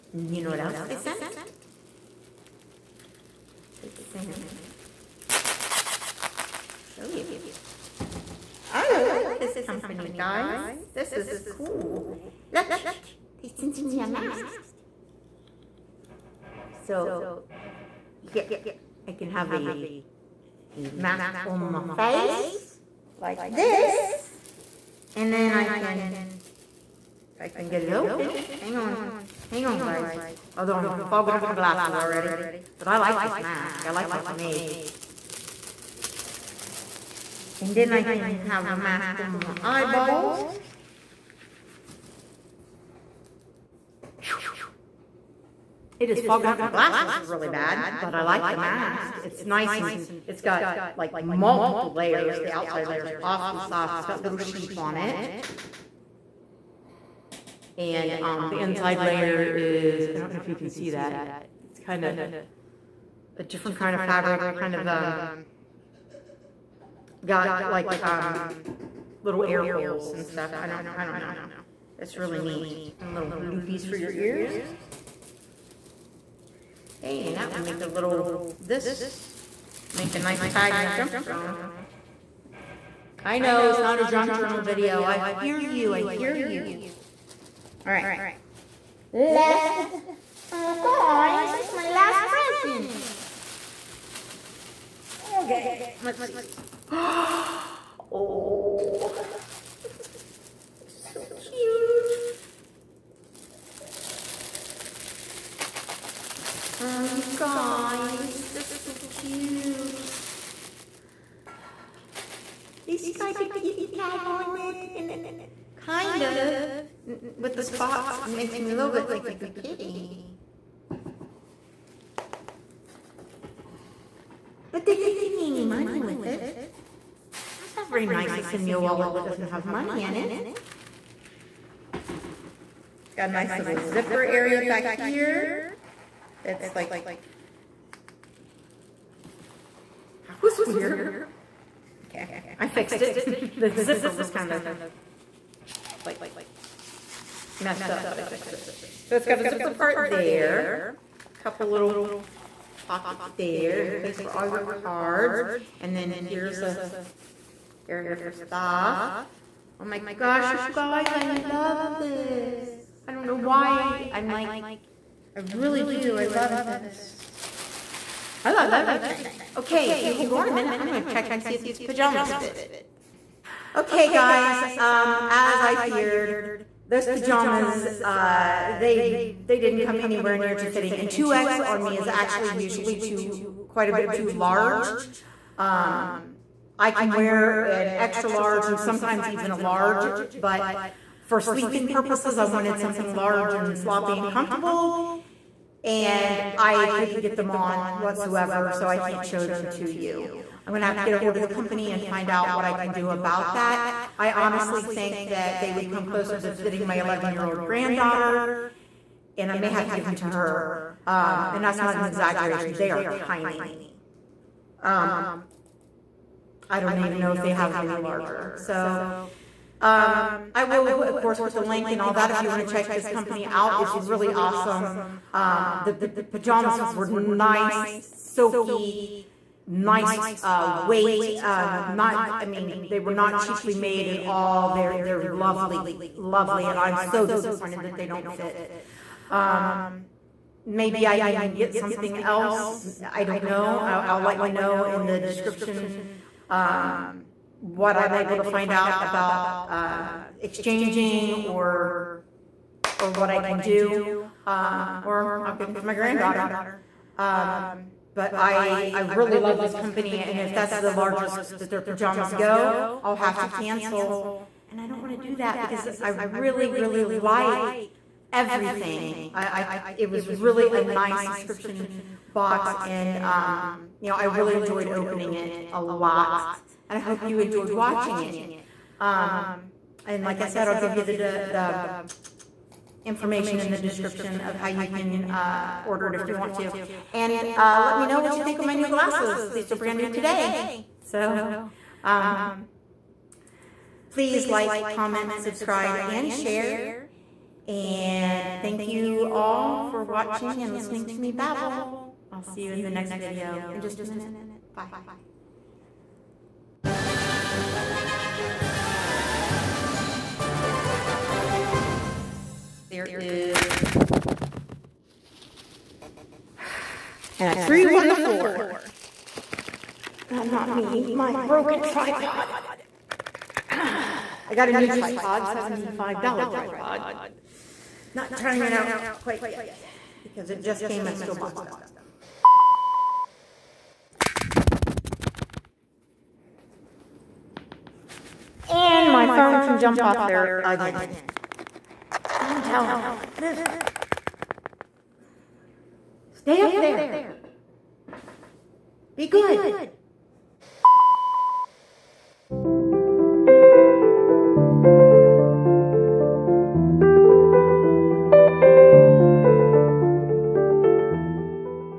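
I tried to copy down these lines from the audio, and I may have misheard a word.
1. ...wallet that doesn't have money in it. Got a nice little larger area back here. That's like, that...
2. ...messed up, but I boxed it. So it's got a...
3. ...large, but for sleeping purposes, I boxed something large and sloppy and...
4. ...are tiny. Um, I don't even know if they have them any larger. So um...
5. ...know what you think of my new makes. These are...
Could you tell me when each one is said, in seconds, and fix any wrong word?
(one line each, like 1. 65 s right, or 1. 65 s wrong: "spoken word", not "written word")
1. 128 s wrong: "zipper", not "larger"
2. 147 s wrong: "fixed", not "boxed"
3. 189 s wrong: "wanted", not "boxed"
4. 212 s right
5. 288 s wrong: "glasses", not "makes".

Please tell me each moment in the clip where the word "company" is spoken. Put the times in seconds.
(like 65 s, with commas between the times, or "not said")
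9 s, 201 s, 223 s, 259 s.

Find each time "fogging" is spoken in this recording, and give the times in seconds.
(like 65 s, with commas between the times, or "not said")
31 s, 46 s.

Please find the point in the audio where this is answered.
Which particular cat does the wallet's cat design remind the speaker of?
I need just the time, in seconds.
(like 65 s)
119 s.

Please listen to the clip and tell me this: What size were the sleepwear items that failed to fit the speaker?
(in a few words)
2X.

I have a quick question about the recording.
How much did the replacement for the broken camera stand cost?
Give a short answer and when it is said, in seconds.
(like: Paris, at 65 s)
$75, at 325 s.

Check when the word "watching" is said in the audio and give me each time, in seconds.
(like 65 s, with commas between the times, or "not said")
277 s, 300 s.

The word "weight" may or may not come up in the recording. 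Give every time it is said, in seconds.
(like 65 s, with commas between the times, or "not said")
230 s.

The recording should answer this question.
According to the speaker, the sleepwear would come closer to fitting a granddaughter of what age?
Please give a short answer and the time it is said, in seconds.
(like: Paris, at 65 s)
11, at 206 s.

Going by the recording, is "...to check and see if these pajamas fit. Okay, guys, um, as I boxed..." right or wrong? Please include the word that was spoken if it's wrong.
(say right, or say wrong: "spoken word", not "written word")
wrong: "feared", not "boxed".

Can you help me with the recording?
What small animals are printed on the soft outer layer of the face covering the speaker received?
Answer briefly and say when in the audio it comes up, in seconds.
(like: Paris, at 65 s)
Sheep, at 54 s.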